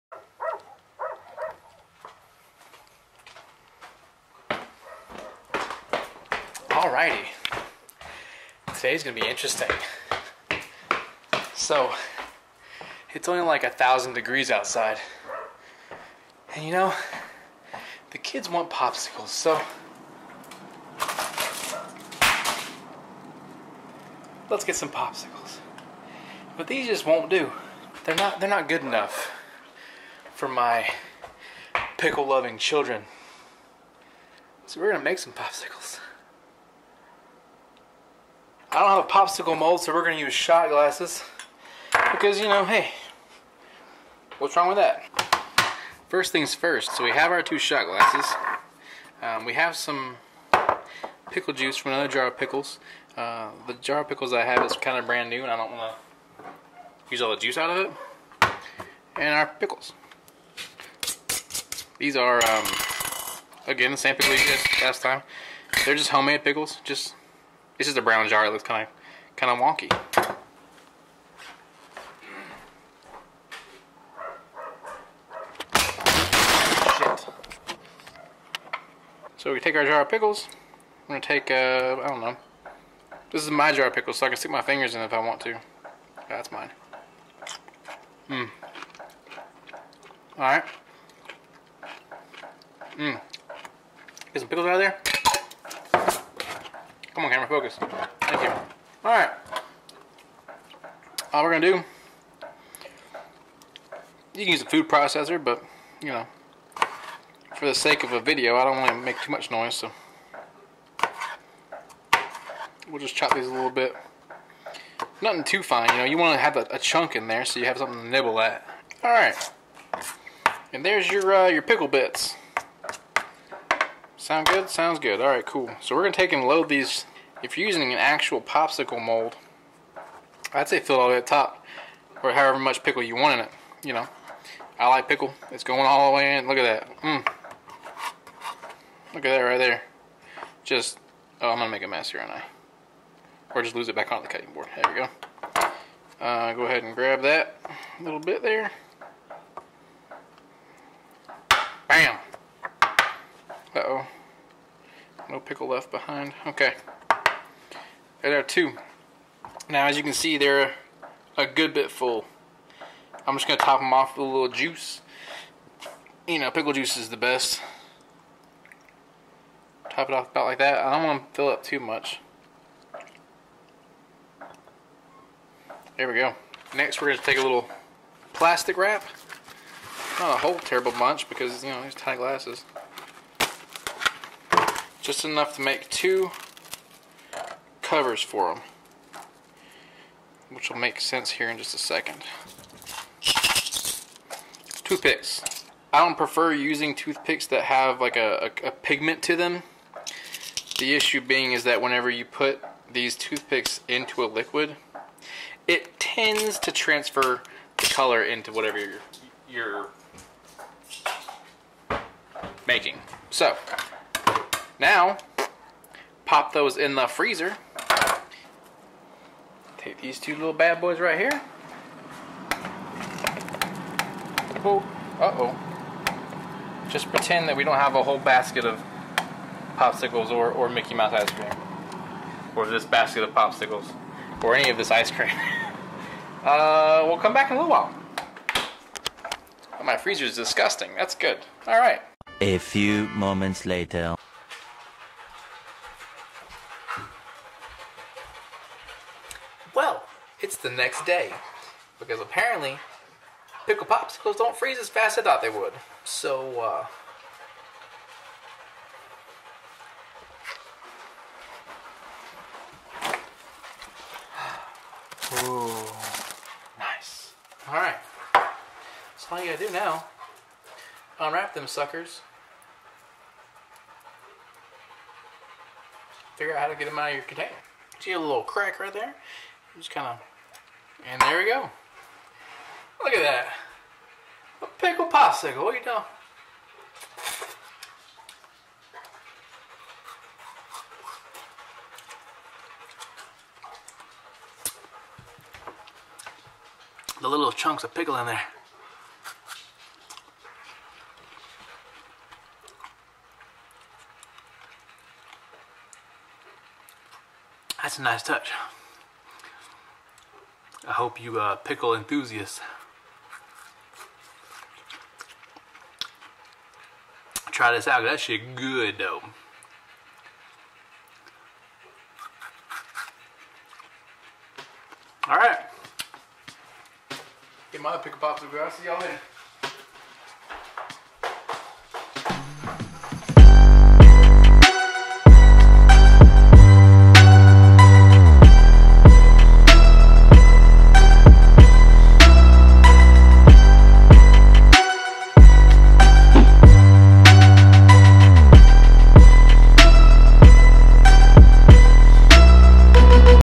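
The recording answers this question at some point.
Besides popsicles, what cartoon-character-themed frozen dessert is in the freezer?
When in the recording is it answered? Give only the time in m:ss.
3:50.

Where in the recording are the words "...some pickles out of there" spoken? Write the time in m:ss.
1:34.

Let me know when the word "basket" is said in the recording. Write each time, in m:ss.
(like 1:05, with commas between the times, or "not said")
3:48, 3:52.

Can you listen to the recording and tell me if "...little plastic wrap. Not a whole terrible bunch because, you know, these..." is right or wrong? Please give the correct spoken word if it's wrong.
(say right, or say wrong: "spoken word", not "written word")
right.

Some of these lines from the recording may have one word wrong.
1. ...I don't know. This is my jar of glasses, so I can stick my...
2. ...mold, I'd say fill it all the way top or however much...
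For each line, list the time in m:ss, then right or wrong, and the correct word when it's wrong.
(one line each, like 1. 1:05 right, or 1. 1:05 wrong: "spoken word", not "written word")
1. 1:22 wrong: "pickles", not "glasses"
2. 2:09 right.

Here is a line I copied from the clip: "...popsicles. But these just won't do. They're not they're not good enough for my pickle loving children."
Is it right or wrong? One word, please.
right.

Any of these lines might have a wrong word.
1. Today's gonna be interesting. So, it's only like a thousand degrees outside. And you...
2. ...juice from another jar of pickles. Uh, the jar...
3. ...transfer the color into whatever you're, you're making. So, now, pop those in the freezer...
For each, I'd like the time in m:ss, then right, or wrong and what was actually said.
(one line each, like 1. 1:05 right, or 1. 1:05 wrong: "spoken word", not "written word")
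1. 0:08 right
2. 0:51 right
3. 3:26 right.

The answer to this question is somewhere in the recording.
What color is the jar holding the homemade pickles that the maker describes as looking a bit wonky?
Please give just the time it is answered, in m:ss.
1:08.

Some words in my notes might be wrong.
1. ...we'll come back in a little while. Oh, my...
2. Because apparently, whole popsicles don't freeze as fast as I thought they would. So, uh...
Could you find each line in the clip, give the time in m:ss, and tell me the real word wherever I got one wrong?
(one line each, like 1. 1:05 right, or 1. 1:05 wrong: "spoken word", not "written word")
1. 3:57 right
2. 4:11 wrong: "pickle", not "whole".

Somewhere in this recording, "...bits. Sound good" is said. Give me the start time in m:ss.
2:01.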